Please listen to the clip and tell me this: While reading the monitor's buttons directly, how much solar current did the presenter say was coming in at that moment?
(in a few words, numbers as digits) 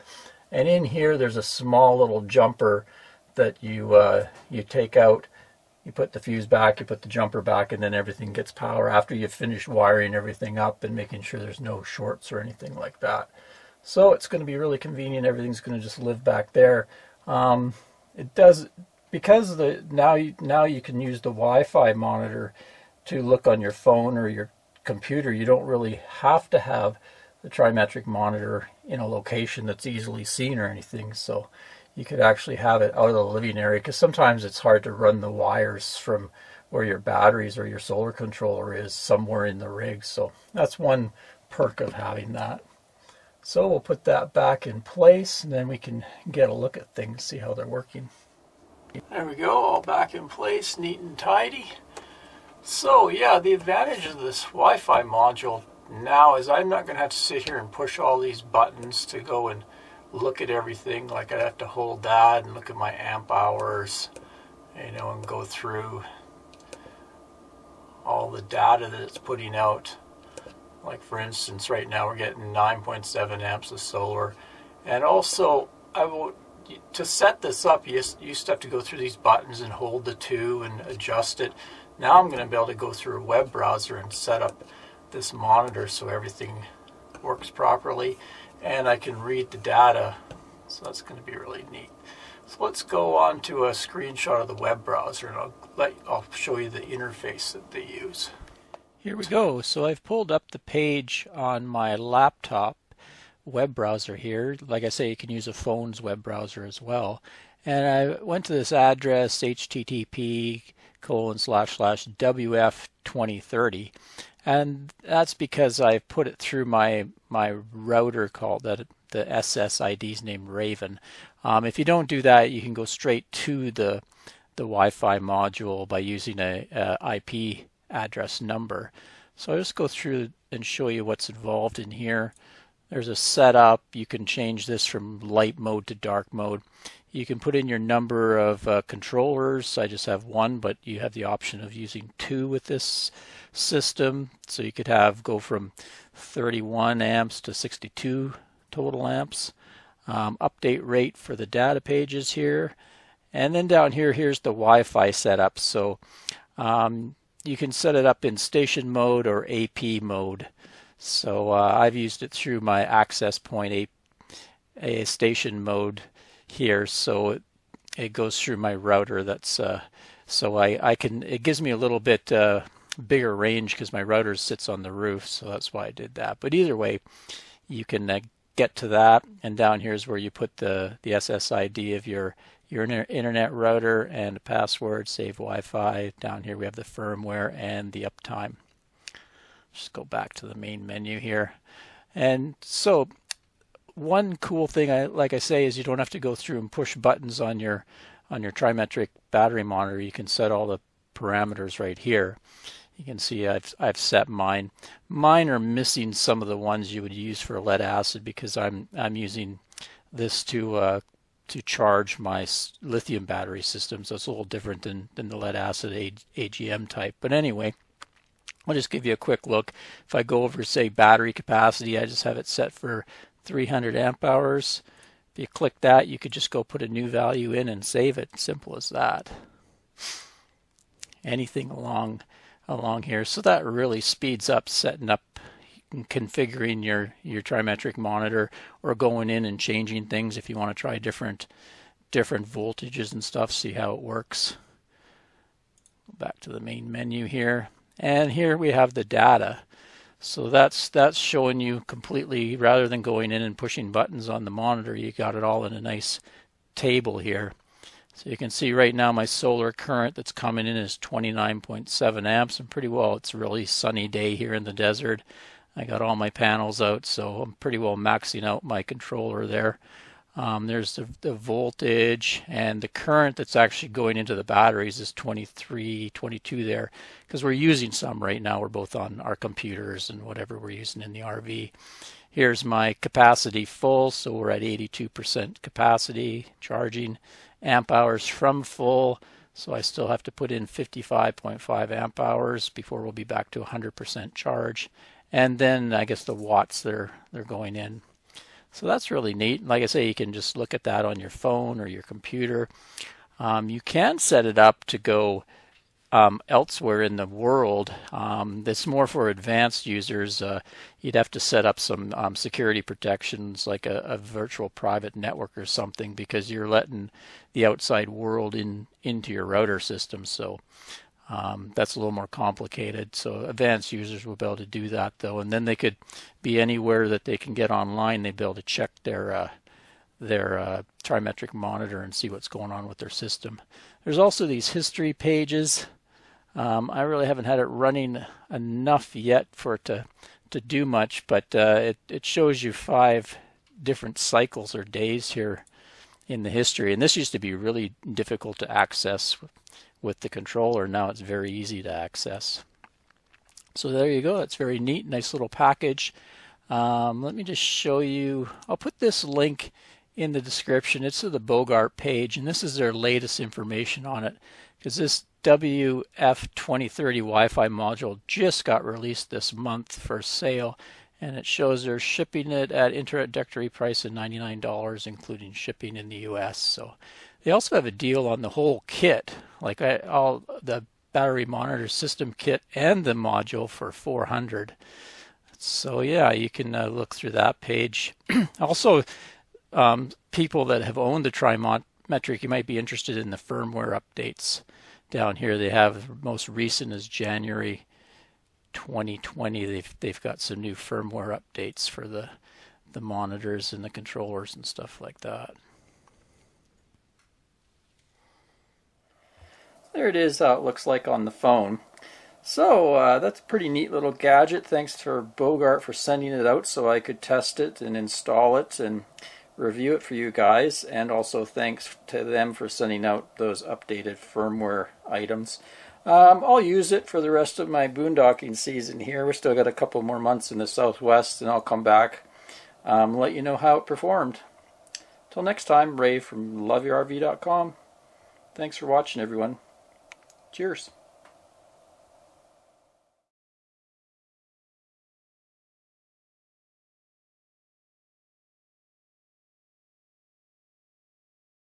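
9.7 amps.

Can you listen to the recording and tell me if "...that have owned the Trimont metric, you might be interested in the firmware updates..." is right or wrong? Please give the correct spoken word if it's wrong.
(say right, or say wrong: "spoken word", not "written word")
right.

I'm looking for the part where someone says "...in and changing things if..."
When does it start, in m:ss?
3:59.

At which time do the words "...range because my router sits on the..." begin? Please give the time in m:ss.
2:53.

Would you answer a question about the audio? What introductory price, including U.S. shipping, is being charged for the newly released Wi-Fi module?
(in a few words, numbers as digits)
$99.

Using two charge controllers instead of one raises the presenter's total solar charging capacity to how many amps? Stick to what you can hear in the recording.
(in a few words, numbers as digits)
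62.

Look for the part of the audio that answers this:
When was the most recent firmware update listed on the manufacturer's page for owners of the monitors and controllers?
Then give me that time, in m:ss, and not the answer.
6:37.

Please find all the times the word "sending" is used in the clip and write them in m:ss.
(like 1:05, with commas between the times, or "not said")
6:55, 7:02.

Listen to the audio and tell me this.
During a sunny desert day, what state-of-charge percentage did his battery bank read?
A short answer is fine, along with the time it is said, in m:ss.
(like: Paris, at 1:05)
82%, at 4:44.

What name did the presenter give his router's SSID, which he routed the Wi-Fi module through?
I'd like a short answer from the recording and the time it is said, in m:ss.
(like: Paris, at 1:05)
Raven, at 2:00.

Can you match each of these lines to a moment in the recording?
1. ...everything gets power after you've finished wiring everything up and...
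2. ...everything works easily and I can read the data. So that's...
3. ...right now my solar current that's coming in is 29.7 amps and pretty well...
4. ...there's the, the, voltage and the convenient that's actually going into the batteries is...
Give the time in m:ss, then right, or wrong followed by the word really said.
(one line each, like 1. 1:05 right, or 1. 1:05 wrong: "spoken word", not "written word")
1. 0:07 right
2. 1:26 wrong: "properly", not "easily"
3. 4:18 right
4. 4:30 wrong: "current", not "convenient".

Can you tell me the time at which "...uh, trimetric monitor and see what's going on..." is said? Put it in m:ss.
5:30.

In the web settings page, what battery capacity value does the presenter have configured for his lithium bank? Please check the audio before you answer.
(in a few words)
300 amp hours.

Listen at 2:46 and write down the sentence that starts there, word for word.
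So it, it goes through my router.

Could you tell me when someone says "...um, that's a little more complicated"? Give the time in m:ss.
5:21.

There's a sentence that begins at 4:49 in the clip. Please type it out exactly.
So I still have to put in 55.5 amp hours before we'll be back to 100% charge.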